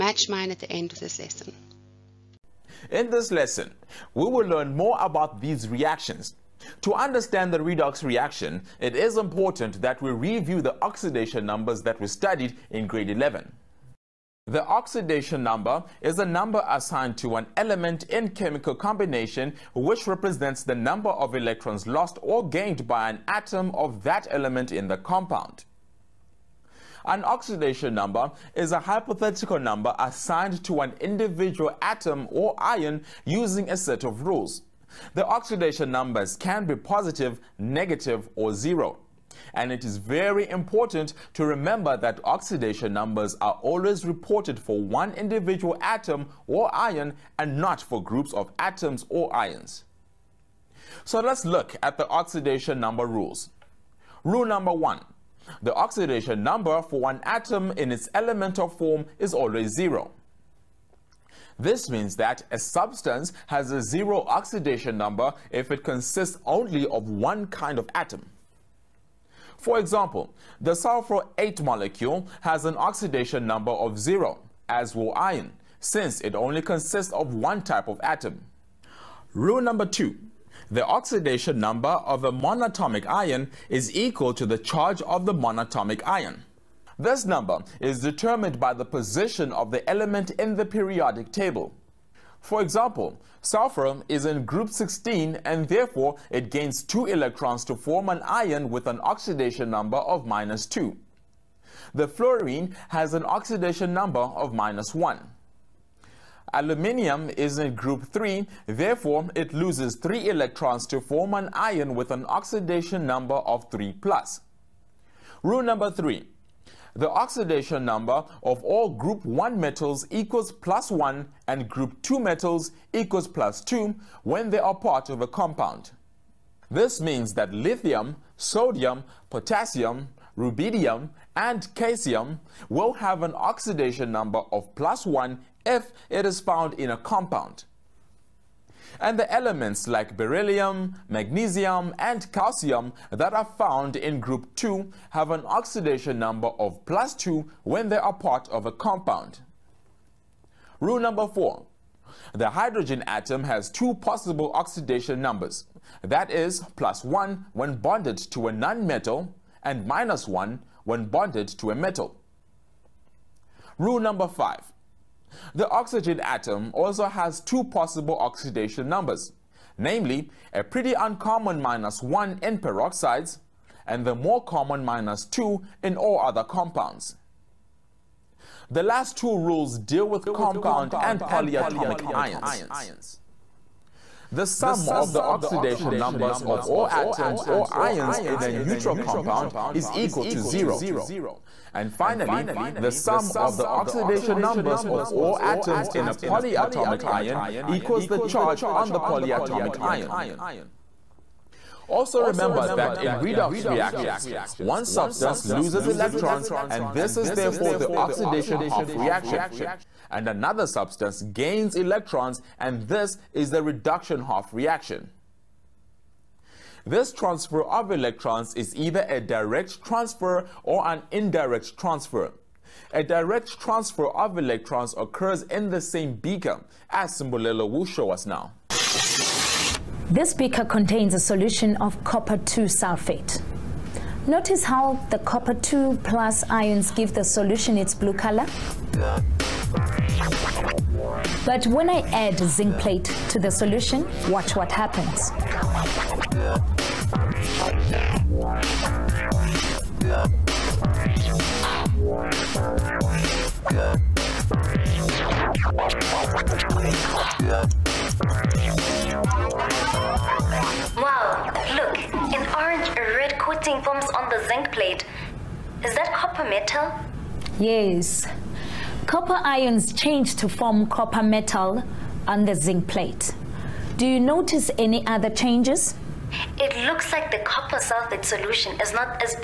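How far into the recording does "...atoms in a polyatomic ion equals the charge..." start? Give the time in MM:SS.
03:15.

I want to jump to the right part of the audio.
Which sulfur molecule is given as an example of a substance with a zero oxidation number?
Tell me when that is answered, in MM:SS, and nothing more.
01:10.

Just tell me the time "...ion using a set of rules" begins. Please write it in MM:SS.
00:32.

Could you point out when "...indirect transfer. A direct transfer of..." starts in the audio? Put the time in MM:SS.
03:41.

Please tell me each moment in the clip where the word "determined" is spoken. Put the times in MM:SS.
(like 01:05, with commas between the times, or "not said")
01:27.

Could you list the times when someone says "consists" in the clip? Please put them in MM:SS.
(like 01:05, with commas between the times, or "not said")
01:05, 01:16.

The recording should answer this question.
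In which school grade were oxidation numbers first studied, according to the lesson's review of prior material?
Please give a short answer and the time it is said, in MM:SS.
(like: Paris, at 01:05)
Grade 11, at 00:12.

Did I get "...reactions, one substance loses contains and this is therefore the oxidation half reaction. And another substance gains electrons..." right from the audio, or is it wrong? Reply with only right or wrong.
wrong.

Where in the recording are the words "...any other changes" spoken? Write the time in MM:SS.
04:34.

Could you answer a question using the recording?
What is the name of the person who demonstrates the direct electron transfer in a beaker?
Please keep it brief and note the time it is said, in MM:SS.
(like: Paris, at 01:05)
Simbolelo, at 03:47.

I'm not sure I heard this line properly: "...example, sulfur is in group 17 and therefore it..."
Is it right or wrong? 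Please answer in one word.
wrong.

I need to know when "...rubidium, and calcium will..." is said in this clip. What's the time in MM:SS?
02:10.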